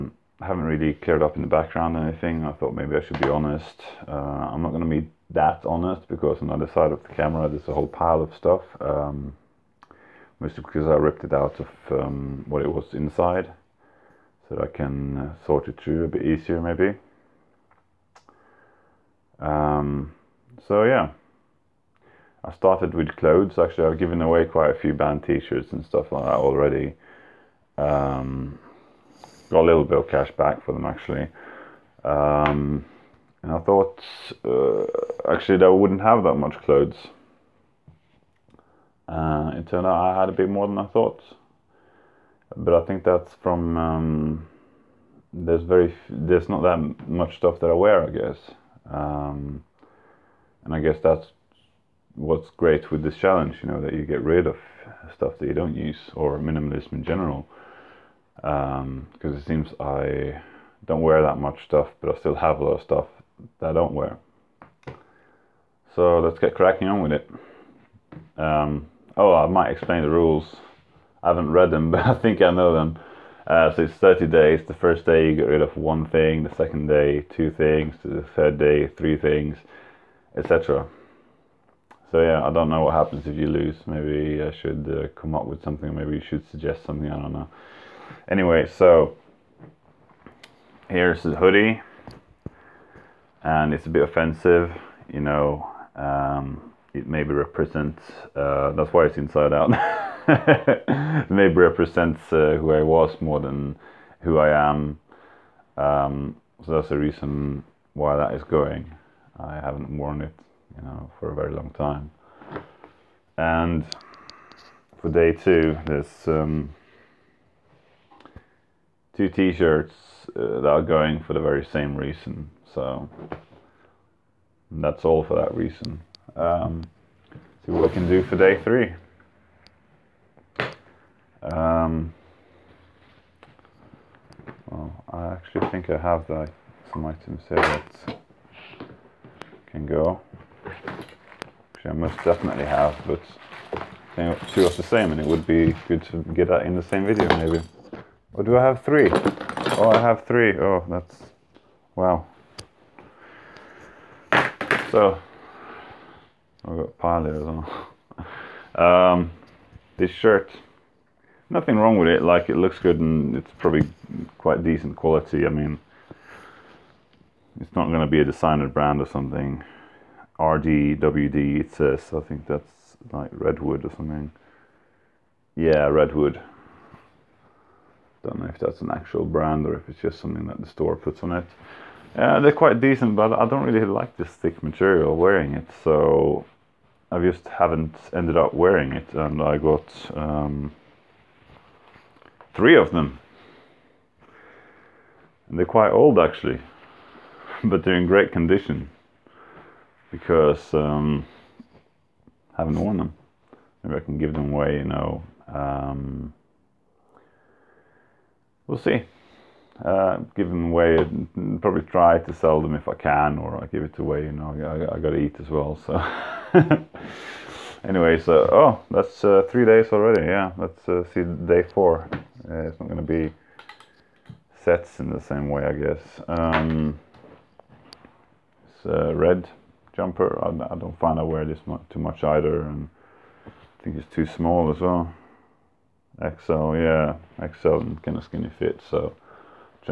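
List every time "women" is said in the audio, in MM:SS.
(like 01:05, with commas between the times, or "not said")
not said.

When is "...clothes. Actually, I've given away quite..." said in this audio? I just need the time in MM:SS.
00:23.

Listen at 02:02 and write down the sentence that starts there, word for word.
So that's all for that reason.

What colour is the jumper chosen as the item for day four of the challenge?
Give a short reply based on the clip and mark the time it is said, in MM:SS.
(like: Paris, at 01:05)
Red, at 03:49.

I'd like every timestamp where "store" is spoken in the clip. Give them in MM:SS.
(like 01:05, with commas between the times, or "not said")
03:00.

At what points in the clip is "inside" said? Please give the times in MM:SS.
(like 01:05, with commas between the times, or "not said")
00:12, 01:39.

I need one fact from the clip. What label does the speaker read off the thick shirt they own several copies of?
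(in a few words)
RDWD.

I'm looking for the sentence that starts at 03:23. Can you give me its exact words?
Maybe I can give them away, you know.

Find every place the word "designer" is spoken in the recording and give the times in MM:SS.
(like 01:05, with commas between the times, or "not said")
02:48.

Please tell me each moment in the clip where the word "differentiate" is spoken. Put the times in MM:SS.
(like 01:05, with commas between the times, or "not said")
not said.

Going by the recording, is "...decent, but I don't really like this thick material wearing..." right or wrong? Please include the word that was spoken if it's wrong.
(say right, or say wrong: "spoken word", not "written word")
right.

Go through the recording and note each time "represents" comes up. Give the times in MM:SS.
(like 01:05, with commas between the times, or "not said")
01:37, 01:41.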